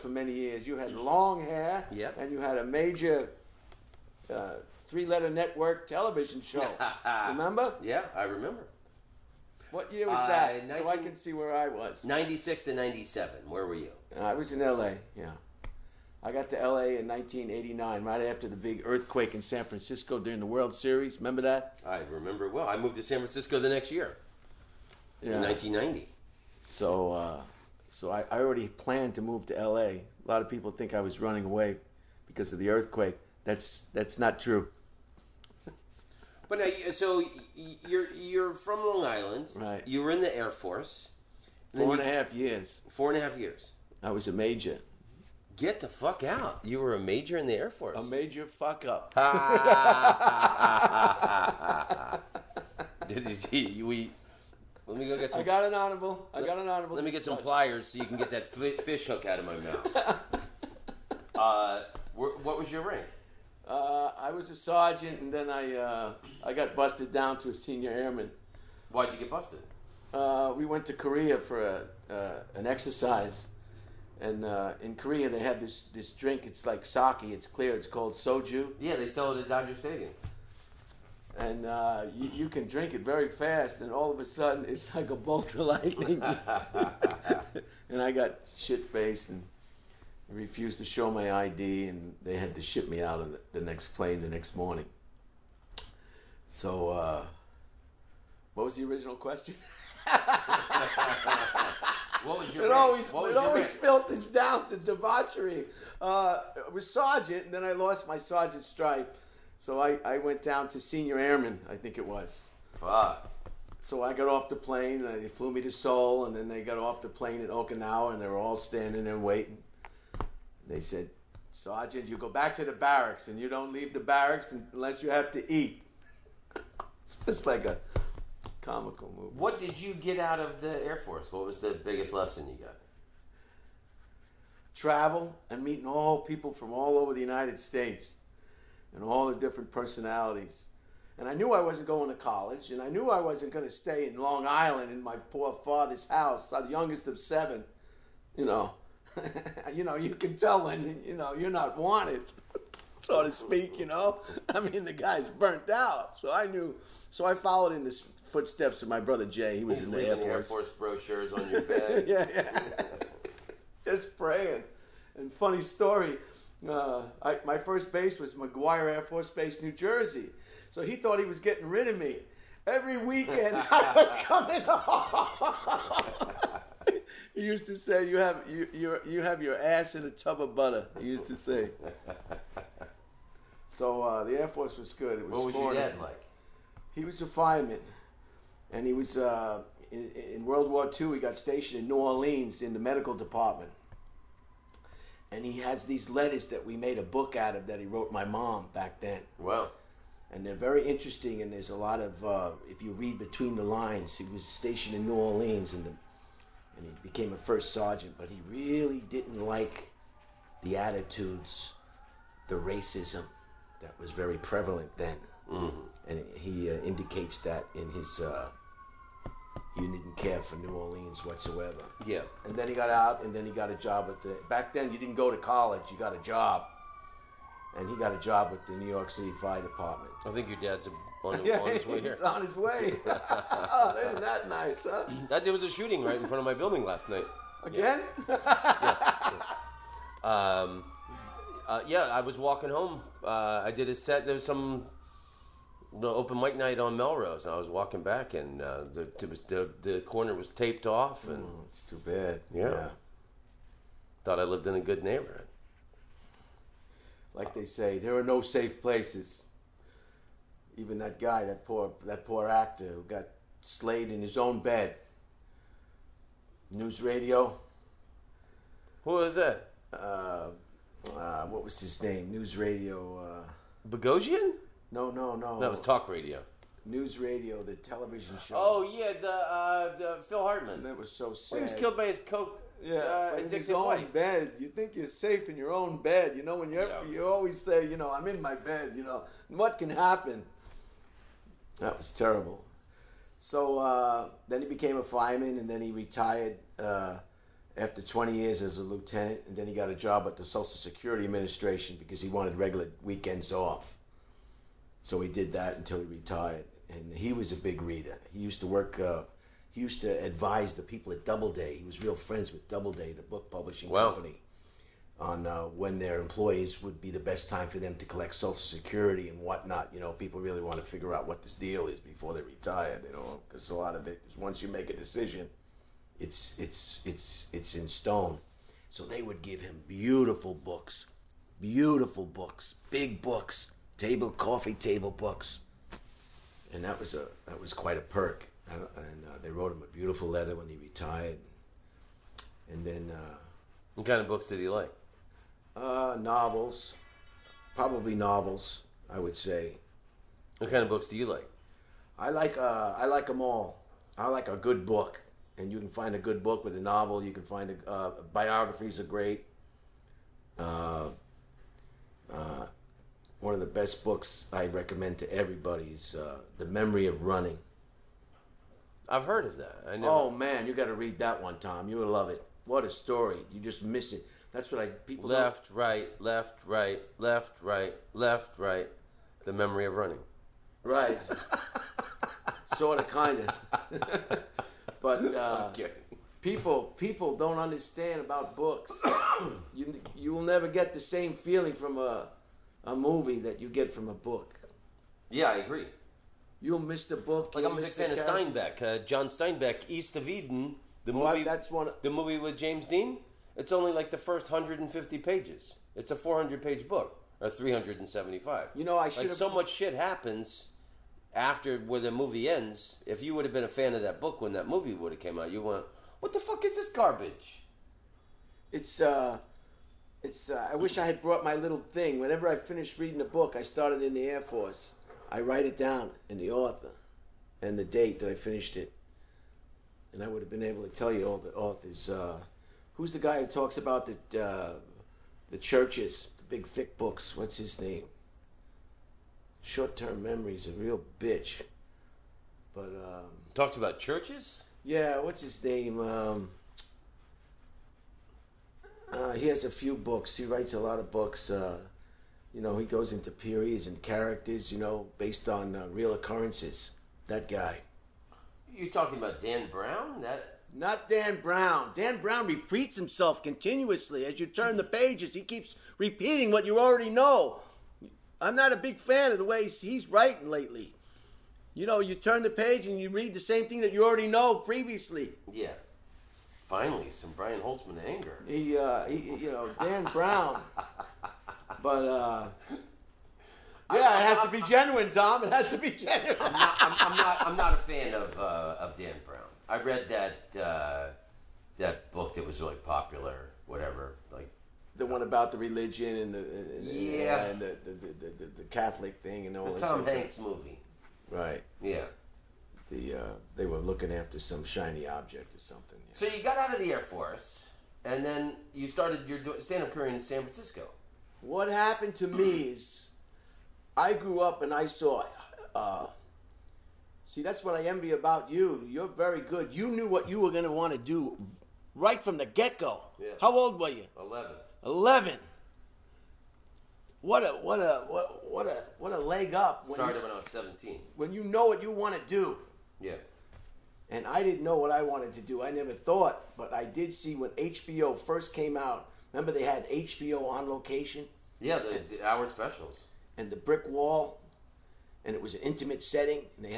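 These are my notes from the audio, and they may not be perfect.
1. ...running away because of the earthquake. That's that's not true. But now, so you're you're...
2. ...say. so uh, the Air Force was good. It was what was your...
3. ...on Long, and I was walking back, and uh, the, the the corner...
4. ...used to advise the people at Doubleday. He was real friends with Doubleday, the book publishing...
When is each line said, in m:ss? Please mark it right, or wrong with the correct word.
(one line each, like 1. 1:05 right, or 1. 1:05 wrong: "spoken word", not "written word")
1. 0:31 right
2. 3:01 right
3. 4:06 wrong: "Melrose", not "Long"
4. 5:09 right.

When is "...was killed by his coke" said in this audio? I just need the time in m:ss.
4:41.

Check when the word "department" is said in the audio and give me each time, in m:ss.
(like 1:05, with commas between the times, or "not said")
3:13, 3:49.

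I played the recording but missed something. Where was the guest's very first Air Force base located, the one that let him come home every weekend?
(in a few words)
McGuire Air Force Base, New Jersey.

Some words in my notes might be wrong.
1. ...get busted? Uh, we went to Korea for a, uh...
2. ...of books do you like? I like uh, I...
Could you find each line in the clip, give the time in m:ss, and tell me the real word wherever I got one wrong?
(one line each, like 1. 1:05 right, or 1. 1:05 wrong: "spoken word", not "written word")
1. 1:09 right
2. 5:50 right.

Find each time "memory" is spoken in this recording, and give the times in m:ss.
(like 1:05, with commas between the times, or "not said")
6:06, 6:19, 7:20.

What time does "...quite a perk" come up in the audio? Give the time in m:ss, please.
5:37.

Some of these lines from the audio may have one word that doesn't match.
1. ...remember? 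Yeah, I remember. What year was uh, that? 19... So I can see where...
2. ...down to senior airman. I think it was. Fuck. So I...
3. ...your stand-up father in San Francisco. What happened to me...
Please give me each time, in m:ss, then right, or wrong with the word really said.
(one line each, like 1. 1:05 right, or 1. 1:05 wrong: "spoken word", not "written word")
1. 0:07 right
2. 1:50 right
3. 8:29 wrong: "career", not "father".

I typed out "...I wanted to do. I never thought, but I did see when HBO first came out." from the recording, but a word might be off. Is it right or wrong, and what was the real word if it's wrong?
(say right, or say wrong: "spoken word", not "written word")
right.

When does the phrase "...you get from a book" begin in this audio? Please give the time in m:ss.
6:33.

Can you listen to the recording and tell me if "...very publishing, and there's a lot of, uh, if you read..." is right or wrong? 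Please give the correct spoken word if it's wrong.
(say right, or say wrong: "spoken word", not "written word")
wrong: "interesting", not "publishing".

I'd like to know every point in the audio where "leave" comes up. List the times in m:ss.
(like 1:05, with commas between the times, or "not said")
2:03.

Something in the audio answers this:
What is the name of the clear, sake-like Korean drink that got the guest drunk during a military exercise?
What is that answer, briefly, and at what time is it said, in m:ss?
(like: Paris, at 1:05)
soju, at 1:18.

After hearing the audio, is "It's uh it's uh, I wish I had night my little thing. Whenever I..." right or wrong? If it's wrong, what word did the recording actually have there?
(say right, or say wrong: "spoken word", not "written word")
wrong: "brought", not "night".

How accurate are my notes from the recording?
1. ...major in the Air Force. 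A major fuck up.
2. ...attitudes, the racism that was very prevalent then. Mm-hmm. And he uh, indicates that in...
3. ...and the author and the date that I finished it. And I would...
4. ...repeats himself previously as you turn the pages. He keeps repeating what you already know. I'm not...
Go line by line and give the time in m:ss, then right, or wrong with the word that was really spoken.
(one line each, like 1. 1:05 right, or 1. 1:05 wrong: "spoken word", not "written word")
1. 0:46 right
2. 3:30 right
3. 7:06 right
4. 7:42 wrong: "continuously", not "previously".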